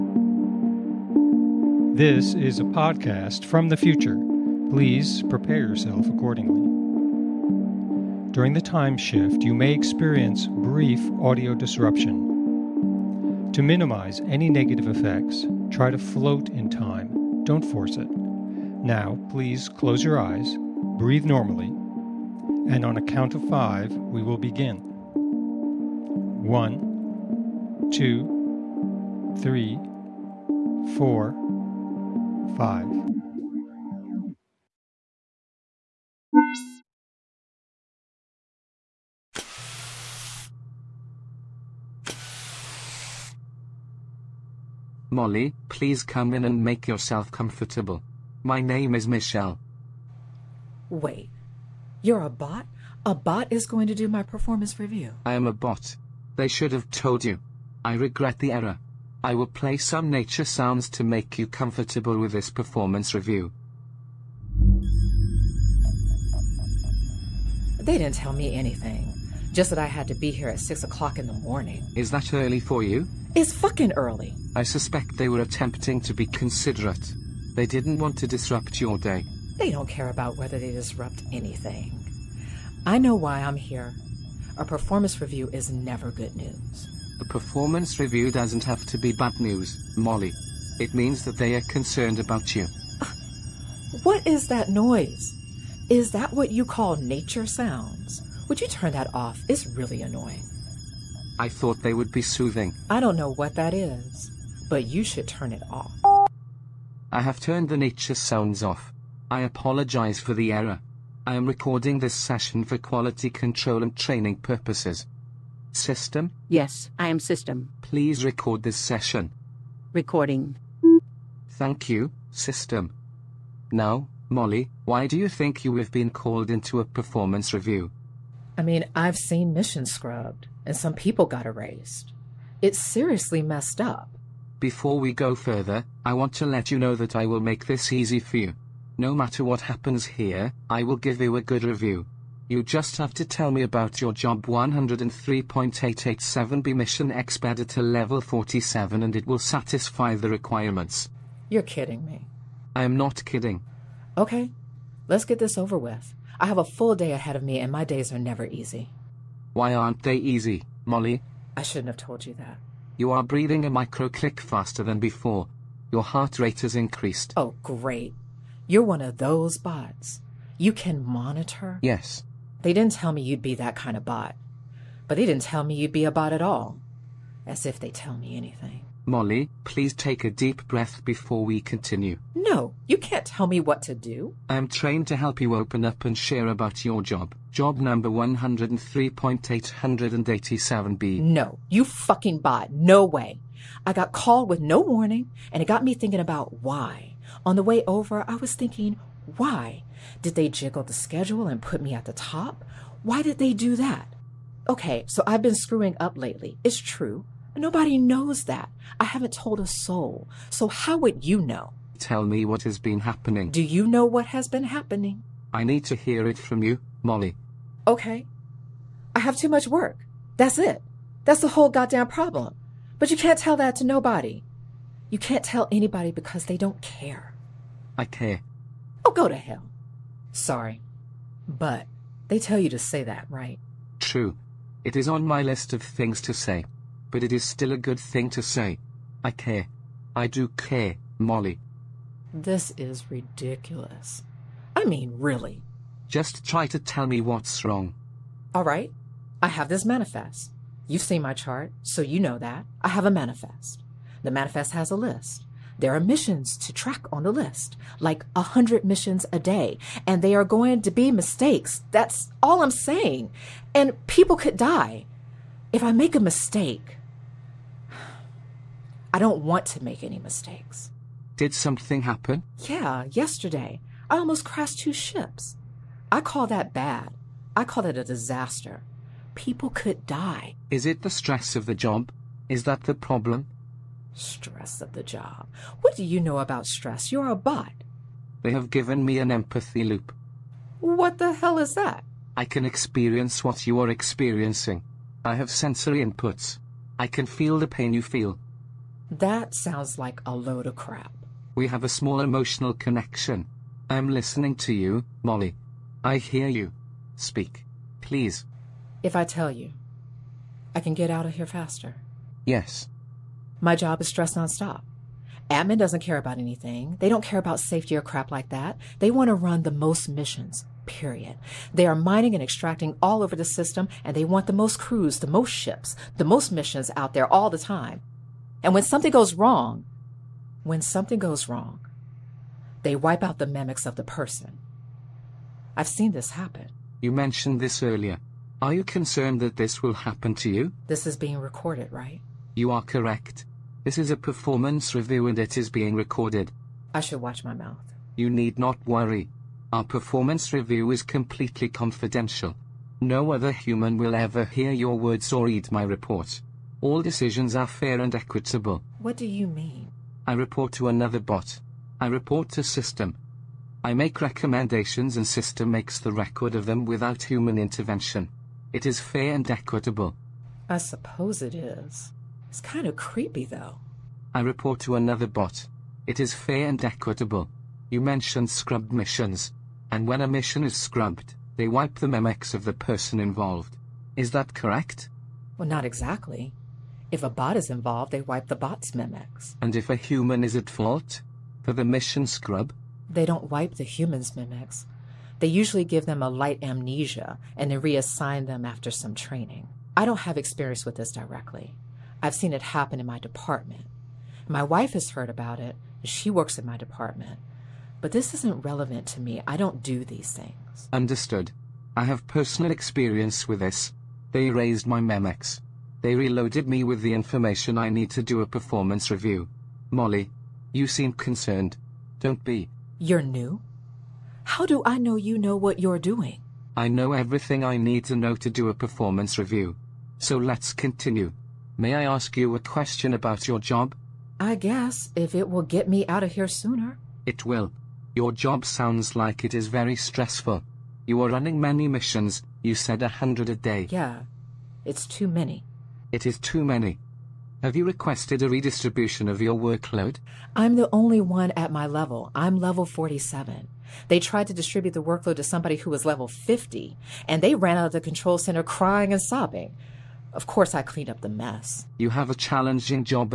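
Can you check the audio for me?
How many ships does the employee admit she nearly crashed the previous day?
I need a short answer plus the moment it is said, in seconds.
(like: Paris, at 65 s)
2, at 274 s.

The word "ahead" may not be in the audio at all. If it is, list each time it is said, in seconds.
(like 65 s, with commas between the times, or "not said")
157 s.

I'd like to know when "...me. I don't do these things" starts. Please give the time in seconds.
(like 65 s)
409 s.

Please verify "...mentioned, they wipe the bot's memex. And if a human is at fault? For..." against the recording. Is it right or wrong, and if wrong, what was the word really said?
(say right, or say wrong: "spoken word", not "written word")
wrong: "involved", not "mentioned".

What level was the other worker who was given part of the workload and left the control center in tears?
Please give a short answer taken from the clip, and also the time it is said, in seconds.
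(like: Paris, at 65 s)
50, at 456 s.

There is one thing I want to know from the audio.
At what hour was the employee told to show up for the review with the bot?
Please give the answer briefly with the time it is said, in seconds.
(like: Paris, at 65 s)
6 o'clock, at 70 s.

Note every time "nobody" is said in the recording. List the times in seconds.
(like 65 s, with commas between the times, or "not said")
207 s, 223 s.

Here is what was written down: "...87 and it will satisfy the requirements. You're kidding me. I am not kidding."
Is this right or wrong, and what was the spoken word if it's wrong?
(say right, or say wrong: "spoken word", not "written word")
wrong: "47", not "87".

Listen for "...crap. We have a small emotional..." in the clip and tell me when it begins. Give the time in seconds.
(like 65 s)
300 s.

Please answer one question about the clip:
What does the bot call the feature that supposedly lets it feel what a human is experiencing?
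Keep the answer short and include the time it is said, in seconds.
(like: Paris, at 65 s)
empathy loop, at 289 s.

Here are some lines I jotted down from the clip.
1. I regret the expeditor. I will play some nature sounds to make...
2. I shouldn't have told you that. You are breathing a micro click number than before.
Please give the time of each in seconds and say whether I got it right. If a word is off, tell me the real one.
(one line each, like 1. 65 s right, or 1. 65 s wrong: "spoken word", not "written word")
1. 57 s wrong: "error", not "expeditor"
2. 161 s wrong: "faster", not "number".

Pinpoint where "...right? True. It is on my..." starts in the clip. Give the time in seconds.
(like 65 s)
233 s.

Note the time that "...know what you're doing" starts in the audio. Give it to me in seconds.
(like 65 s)
425 s.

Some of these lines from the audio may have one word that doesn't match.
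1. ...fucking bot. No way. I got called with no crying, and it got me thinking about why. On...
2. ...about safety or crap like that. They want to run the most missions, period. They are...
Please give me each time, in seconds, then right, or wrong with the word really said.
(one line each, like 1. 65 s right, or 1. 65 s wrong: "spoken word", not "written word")
1. 191 s wrong: "warning", not "crying"
2. 317 s right.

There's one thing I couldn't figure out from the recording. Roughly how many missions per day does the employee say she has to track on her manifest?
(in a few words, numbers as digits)
100.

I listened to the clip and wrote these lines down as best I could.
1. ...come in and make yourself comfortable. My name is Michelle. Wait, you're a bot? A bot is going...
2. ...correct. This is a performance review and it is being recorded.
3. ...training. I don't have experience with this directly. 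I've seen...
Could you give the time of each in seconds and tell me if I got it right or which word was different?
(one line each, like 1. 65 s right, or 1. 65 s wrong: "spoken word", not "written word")
1. 46 s right
2. 342 s right
3. 399 s right.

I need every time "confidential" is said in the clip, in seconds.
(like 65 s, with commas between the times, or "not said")
351 s.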